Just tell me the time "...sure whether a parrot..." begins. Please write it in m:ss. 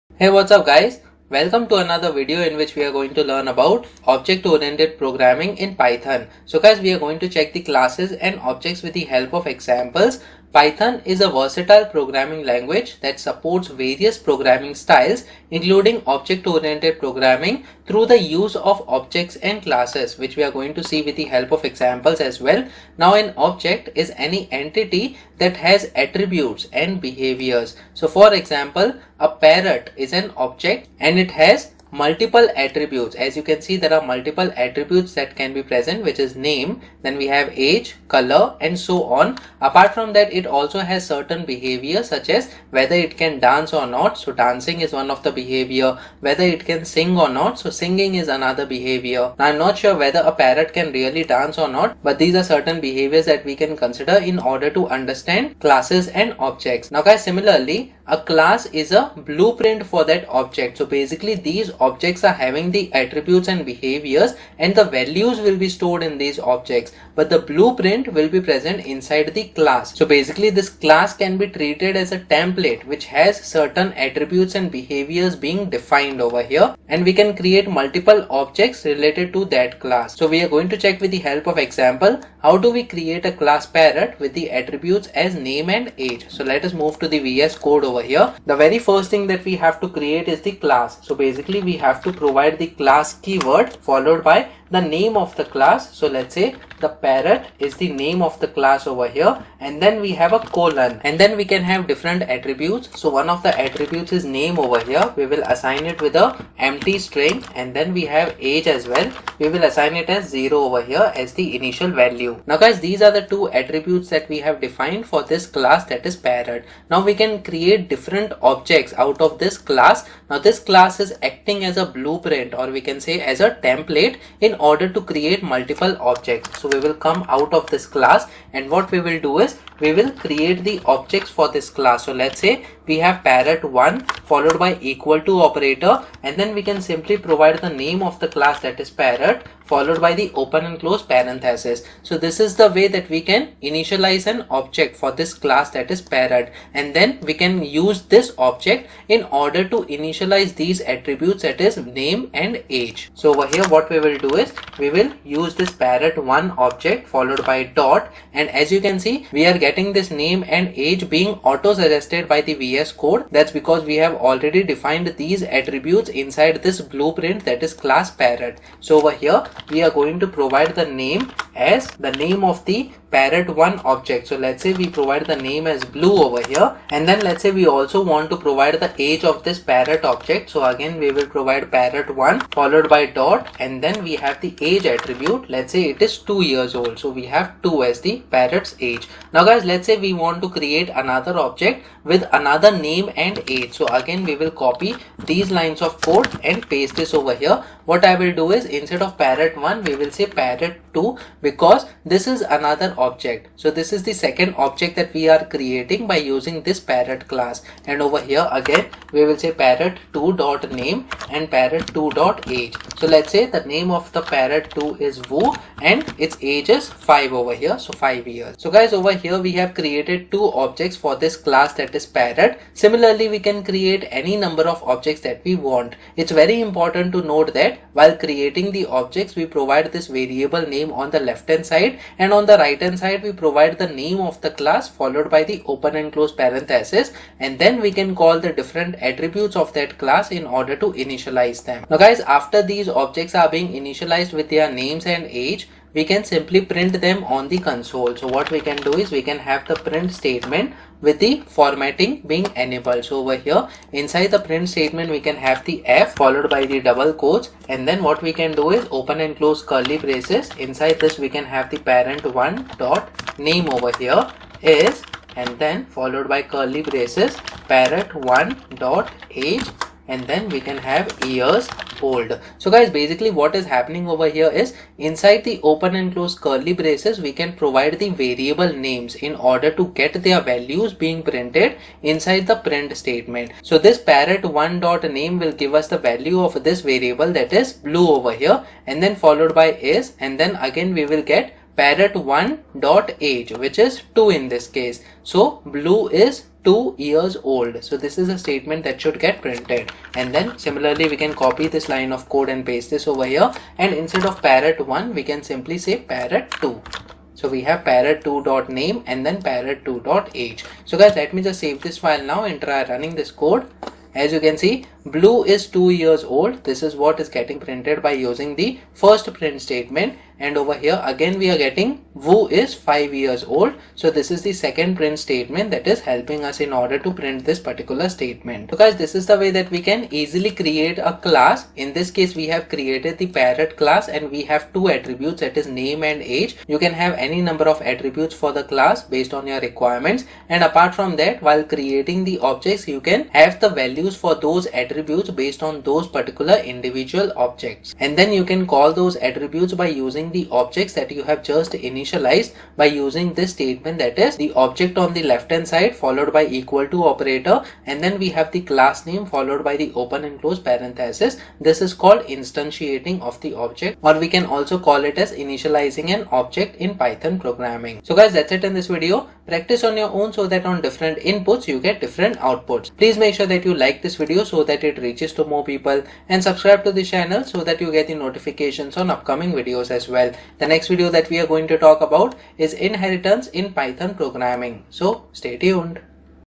0:49.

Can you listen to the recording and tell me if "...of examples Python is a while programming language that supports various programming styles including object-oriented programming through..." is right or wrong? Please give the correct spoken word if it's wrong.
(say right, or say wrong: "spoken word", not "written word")
wrong: "versatile", not "while".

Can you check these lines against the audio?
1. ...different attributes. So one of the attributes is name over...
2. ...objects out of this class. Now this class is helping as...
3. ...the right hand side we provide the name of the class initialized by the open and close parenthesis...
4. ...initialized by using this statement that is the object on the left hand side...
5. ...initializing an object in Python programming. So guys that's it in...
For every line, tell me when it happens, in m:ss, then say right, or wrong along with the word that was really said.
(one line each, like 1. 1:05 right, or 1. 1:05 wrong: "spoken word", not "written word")
1. 1:41 right
2. 1:58 wrong: "acting", not "helping"
3. 3:52 wrong: "followed", not "initialized"
4. 5:51 right
5. 6:05 right.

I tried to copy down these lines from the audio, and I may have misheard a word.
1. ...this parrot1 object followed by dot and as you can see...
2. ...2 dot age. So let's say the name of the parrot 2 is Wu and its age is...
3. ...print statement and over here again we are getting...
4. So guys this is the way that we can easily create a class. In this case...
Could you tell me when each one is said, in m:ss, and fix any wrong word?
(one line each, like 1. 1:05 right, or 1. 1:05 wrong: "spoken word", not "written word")
1. 2:35 right
2. 3:31 right
3. 5:19 right
4. 5:28 right.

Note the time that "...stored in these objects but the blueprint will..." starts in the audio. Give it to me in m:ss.
1:05.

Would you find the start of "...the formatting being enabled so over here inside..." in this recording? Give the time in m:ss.
4:11.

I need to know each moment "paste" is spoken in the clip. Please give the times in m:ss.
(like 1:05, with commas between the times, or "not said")
3:16, 5:02.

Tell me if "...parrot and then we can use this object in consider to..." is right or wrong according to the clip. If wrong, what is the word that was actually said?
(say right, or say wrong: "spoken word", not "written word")
wrong: "order", not "consider".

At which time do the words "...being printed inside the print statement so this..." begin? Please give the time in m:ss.
4:41.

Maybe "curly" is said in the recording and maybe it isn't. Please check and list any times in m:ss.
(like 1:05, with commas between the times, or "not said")
4:19, 4:26, 4:36.